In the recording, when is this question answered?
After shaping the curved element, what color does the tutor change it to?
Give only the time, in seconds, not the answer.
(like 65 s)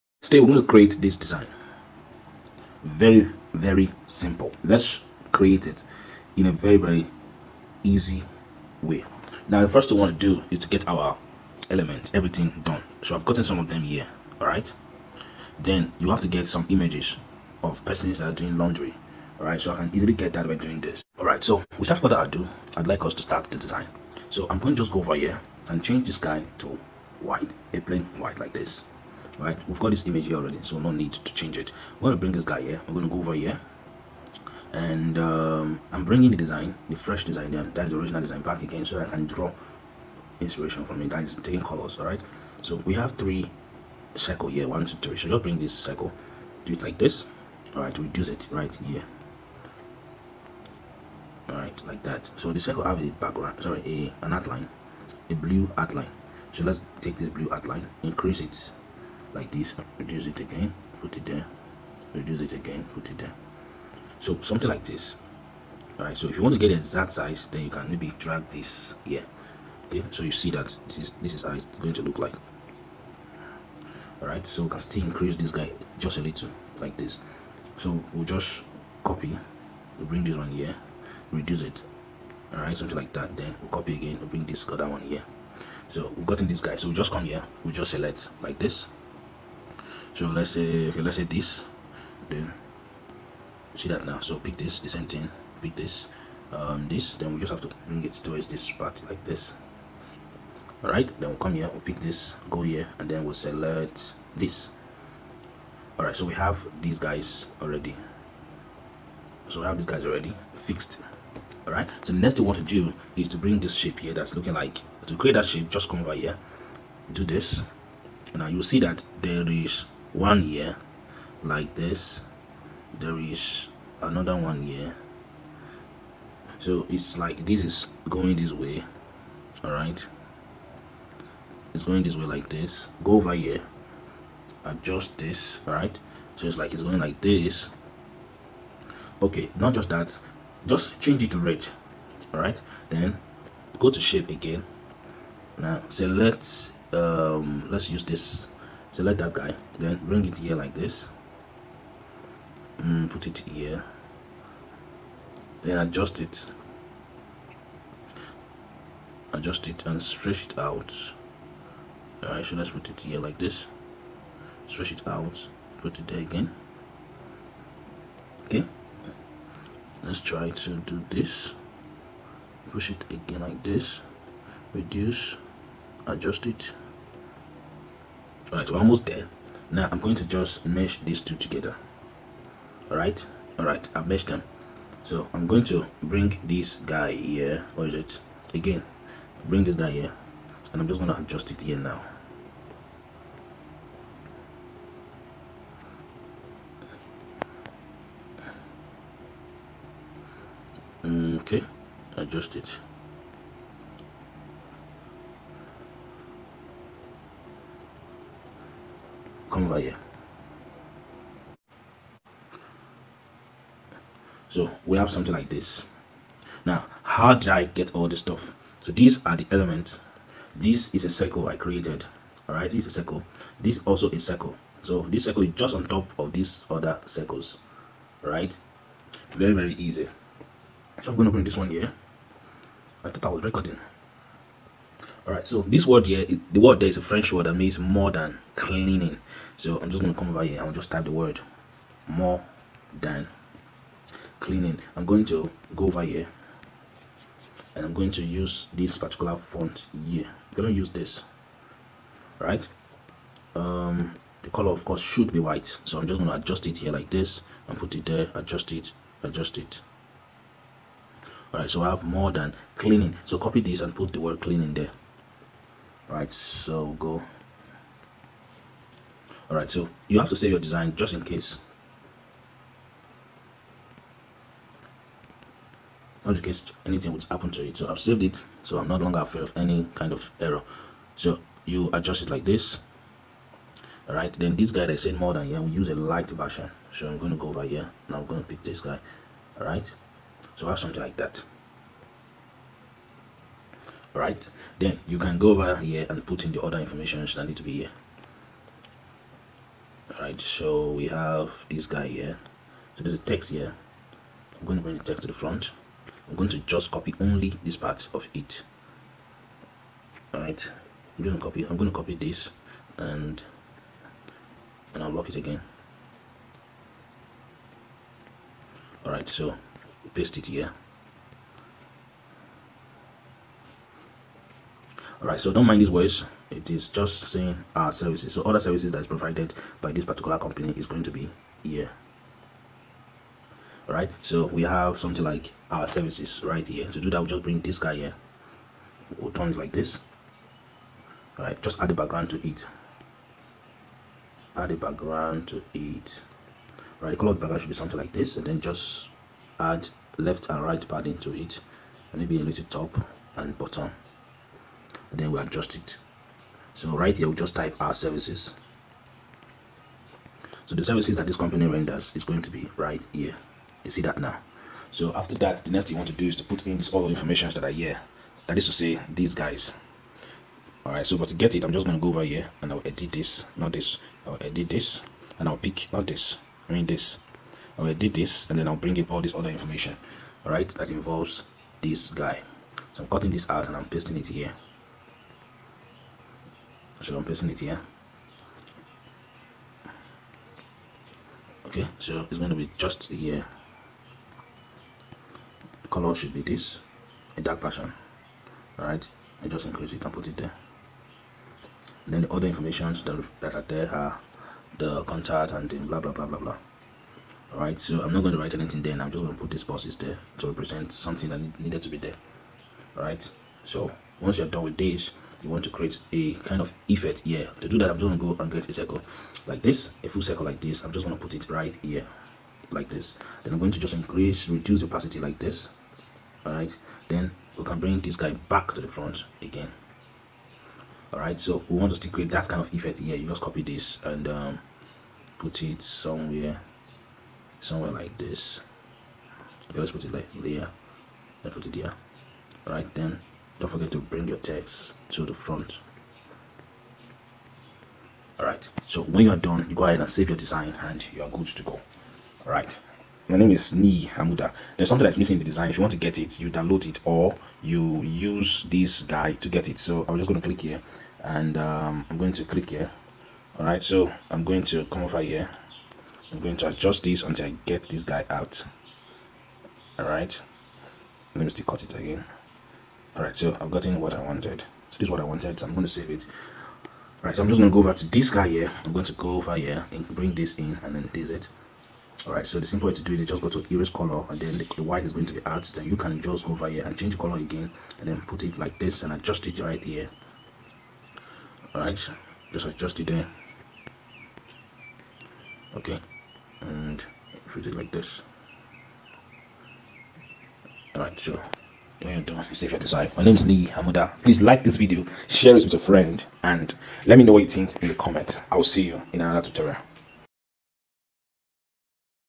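140 s.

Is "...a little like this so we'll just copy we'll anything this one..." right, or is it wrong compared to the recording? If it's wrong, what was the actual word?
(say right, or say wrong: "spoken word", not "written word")
wrong: "bring", not "anything".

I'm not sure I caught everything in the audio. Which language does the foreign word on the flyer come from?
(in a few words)
French.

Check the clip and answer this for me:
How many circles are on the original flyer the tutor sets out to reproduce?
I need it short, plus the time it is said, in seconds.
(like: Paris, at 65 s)
3, at 42 s.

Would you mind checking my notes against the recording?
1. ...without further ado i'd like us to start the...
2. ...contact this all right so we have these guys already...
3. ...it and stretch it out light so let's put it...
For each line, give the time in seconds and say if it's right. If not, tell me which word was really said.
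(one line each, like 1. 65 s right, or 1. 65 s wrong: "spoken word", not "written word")
1. 21 s right
2. 103 s wrong: "select", not "contact"
3. 159 s wrong: "alright", not "light".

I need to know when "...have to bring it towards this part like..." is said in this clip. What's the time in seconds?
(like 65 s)
97 s.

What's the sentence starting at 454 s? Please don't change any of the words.
There's something that's missing in the design.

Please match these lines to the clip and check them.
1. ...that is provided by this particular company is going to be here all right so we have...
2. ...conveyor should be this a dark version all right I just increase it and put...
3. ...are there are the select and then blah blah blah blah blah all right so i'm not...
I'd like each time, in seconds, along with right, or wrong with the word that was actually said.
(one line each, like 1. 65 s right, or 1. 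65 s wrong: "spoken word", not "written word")
1. 328 s right
2. 395 s wrong: "color", not "conveyor"
3. 403 s wrong: "contact", not "select".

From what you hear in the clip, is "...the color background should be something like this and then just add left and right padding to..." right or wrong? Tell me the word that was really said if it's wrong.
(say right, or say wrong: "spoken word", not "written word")
right.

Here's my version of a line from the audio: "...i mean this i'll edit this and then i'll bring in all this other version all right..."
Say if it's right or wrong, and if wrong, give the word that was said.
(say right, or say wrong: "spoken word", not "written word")
wrong: "information", not "version".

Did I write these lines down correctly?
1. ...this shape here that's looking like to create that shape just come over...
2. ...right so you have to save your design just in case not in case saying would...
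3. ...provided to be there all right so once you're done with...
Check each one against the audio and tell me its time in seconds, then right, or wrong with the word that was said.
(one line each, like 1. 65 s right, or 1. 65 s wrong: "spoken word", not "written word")
1. 113 s right
2. 269 s wrong: "anything", not "saying"
3. 411 s wrong: "needed", not "provided".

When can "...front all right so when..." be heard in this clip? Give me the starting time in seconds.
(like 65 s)
445 s.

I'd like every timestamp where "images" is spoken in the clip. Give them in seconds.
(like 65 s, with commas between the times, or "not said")
16 s, 30 s.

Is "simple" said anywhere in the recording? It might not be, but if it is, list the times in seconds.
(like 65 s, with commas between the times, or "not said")
4 s, 482 s.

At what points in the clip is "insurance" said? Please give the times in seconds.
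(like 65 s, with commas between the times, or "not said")
not said.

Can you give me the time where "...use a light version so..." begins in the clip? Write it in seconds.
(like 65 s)
285 s.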